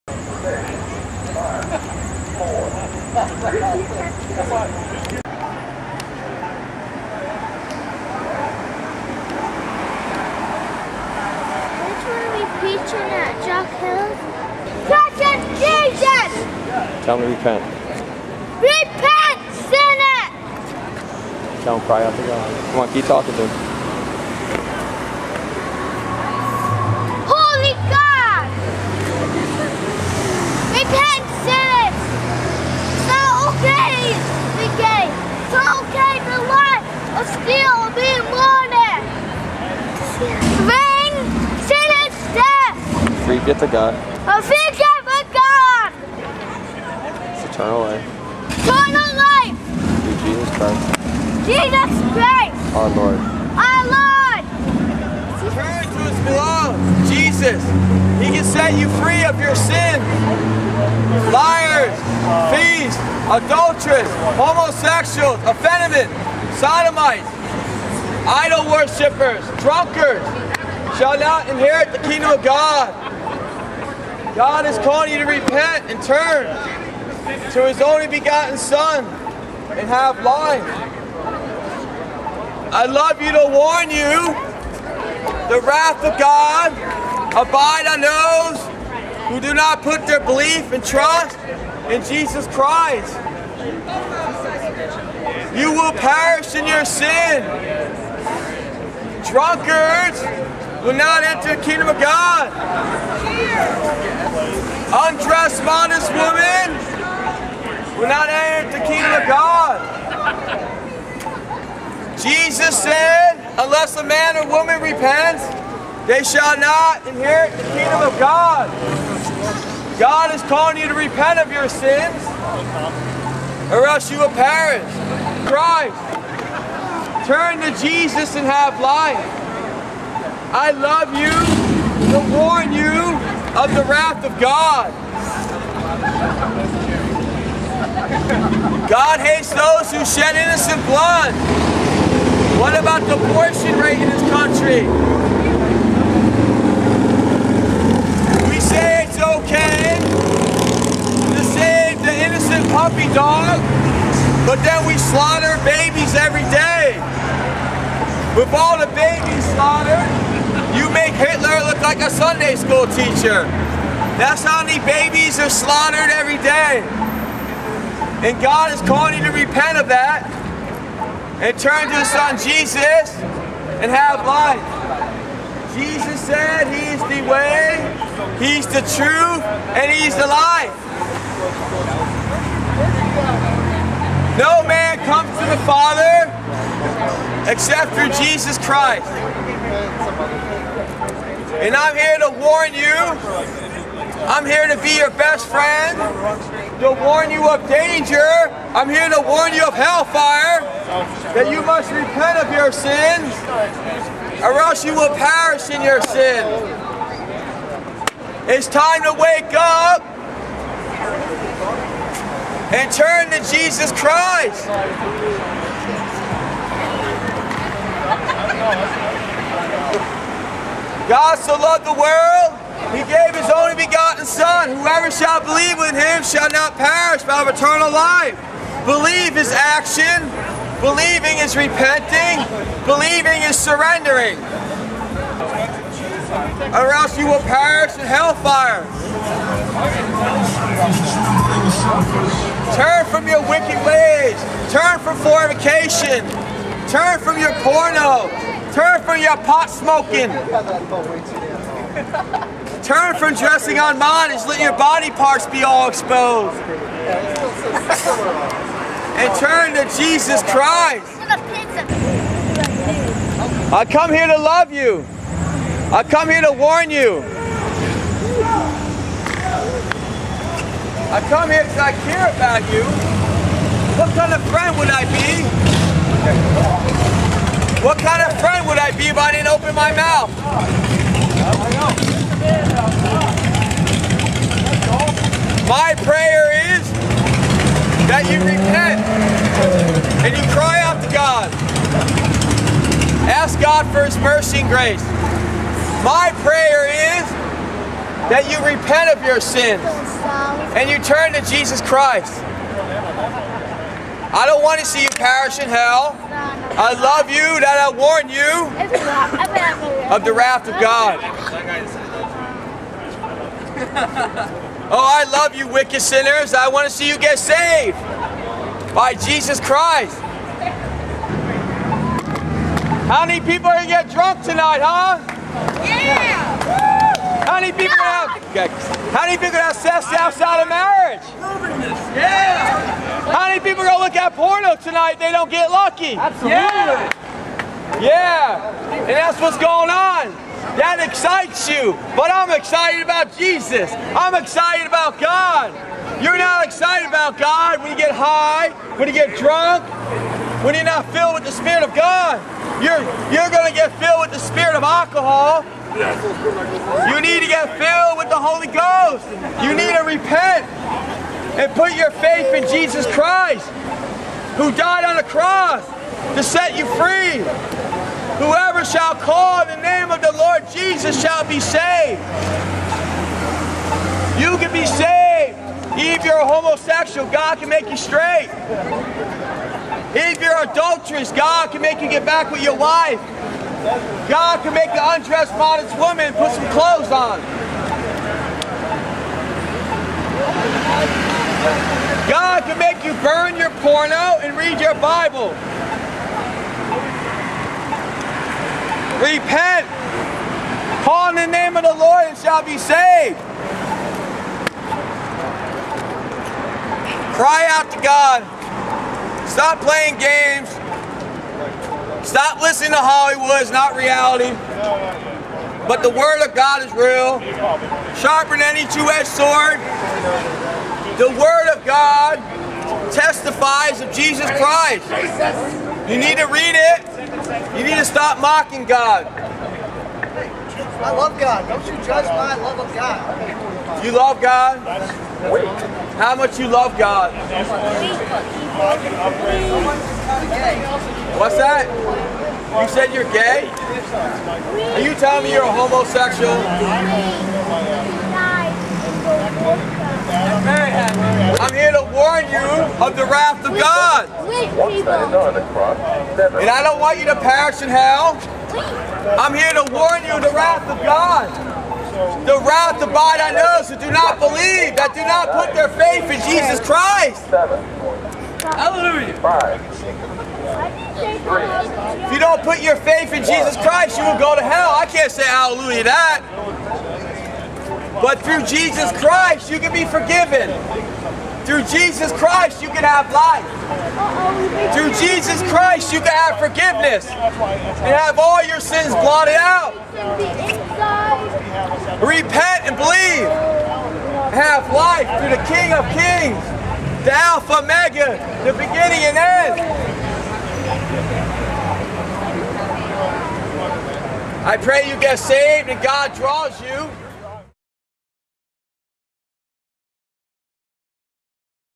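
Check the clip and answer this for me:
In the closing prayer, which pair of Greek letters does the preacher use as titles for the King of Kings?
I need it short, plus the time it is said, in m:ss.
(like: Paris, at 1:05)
Alpha, Omega, at 8:17.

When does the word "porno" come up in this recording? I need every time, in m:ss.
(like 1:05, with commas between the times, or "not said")
4:07, 5:34, 6:33.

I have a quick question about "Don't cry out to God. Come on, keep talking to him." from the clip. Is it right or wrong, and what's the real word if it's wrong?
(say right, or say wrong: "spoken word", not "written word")
right.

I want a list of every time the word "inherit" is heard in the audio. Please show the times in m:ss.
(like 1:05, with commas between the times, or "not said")
1:11, 1:57.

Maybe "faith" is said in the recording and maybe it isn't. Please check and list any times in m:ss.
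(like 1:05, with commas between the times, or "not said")
6:02, 7:45, 7:52.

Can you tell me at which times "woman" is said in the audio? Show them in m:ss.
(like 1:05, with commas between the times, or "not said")
1:46, 1:54, 6:25.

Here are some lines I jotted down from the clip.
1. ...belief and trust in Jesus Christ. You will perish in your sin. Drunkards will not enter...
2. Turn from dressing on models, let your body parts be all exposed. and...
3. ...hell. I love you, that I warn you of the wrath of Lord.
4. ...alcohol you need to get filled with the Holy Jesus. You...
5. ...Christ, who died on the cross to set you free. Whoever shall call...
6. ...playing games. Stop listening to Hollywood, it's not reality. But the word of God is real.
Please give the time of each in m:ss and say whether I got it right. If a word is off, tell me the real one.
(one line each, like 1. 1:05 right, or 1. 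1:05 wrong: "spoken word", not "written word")
1. 1:30 right
2. 4:12 right
3. 5:05 wrong: "God", not "Lord"
4. 5:54 wrong: "Ghost", not "Jesus"
5. 6:03 right
6. 6:49 right.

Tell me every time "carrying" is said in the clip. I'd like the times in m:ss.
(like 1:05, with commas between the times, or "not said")
not said.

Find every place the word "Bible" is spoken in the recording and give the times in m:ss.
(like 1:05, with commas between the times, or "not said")
6:34.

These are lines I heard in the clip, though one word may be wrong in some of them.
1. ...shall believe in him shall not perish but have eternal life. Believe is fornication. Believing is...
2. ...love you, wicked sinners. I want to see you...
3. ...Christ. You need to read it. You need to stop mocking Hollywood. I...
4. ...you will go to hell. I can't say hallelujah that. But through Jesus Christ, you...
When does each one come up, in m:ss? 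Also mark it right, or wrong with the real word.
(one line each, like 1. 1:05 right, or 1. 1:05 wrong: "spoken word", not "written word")
1. 3:45 wrong: "action", not "fornication"
2. 5:15 right
3. 7:04 wrong: "God", not "Hollywood"
4. 7:54 right.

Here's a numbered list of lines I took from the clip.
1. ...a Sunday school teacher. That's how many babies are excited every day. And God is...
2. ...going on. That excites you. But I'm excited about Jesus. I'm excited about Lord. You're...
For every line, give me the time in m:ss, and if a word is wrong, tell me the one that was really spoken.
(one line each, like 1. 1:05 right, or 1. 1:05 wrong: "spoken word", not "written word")
1. 2:42 wrong: "slaughtered", not "excited"
2. 5:39 wrong: "God", not "Lord".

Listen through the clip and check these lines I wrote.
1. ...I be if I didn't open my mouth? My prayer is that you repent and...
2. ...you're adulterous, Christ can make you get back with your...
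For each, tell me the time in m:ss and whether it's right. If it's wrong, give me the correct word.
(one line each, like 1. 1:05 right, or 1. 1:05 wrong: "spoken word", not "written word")
1. 4:38 right
2. 6:20 wrong: "God", not "Christ".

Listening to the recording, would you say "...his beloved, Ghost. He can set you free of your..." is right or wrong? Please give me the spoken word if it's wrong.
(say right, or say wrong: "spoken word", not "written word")
wrong: "Jesus", not "Ghost".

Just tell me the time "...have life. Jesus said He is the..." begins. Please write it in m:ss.
2:53.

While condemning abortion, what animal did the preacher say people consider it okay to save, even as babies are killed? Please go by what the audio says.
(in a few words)
puppy dog.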